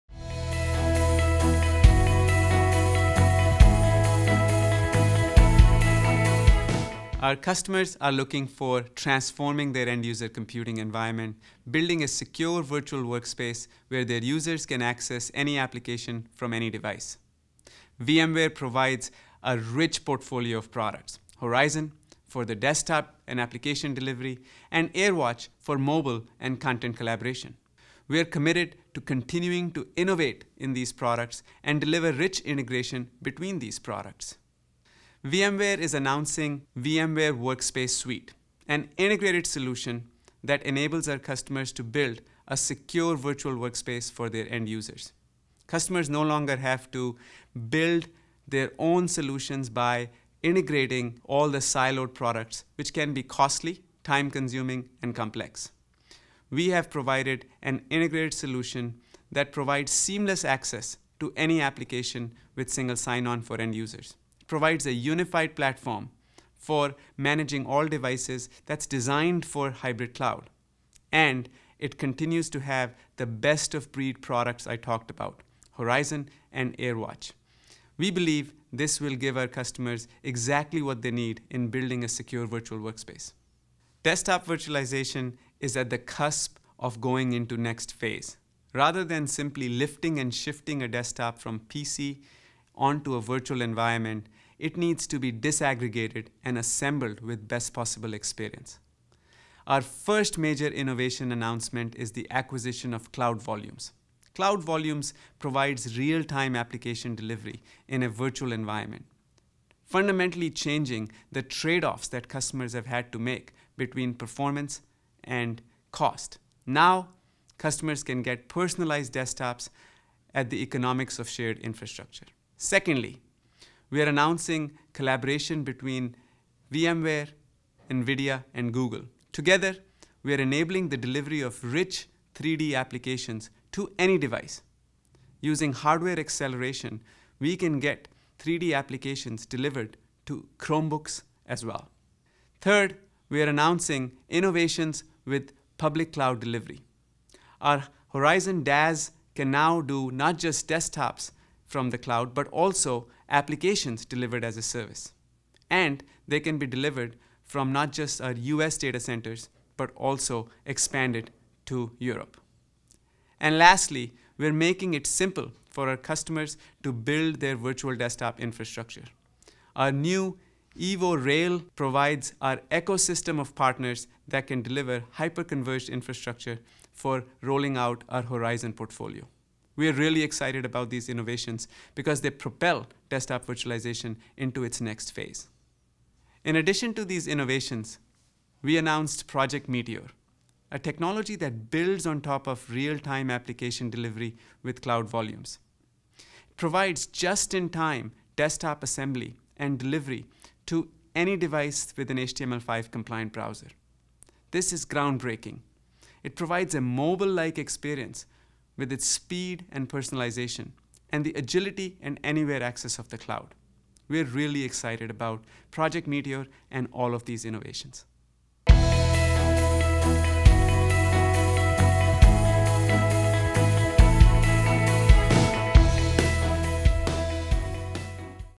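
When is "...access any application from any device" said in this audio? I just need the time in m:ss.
0:14.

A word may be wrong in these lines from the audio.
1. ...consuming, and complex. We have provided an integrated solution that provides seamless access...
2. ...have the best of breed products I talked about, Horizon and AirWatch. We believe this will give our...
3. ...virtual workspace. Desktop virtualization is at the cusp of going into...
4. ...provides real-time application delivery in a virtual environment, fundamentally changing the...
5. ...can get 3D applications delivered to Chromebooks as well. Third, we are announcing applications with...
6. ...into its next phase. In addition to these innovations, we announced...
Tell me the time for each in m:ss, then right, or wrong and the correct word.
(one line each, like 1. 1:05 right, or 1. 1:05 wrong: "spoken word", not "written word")
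1. 0:54 right
2. 1:12 right
3. 1:22 right
4. 1:45 right
5. 2:17 wrong: "innovations", not "applications"
6. 3:04 right.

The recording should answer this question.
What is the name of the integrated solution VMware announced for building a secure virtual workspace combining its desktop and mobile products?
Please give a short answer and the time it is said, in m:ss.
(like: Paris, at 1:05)
Workspace Suite, at 0:37.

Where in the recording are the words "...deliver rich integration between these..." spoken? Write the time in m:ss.
0:31.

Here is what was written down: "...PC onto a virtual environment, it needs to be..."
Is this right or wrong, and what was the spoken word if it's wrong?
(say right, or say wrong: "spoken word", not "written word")
right.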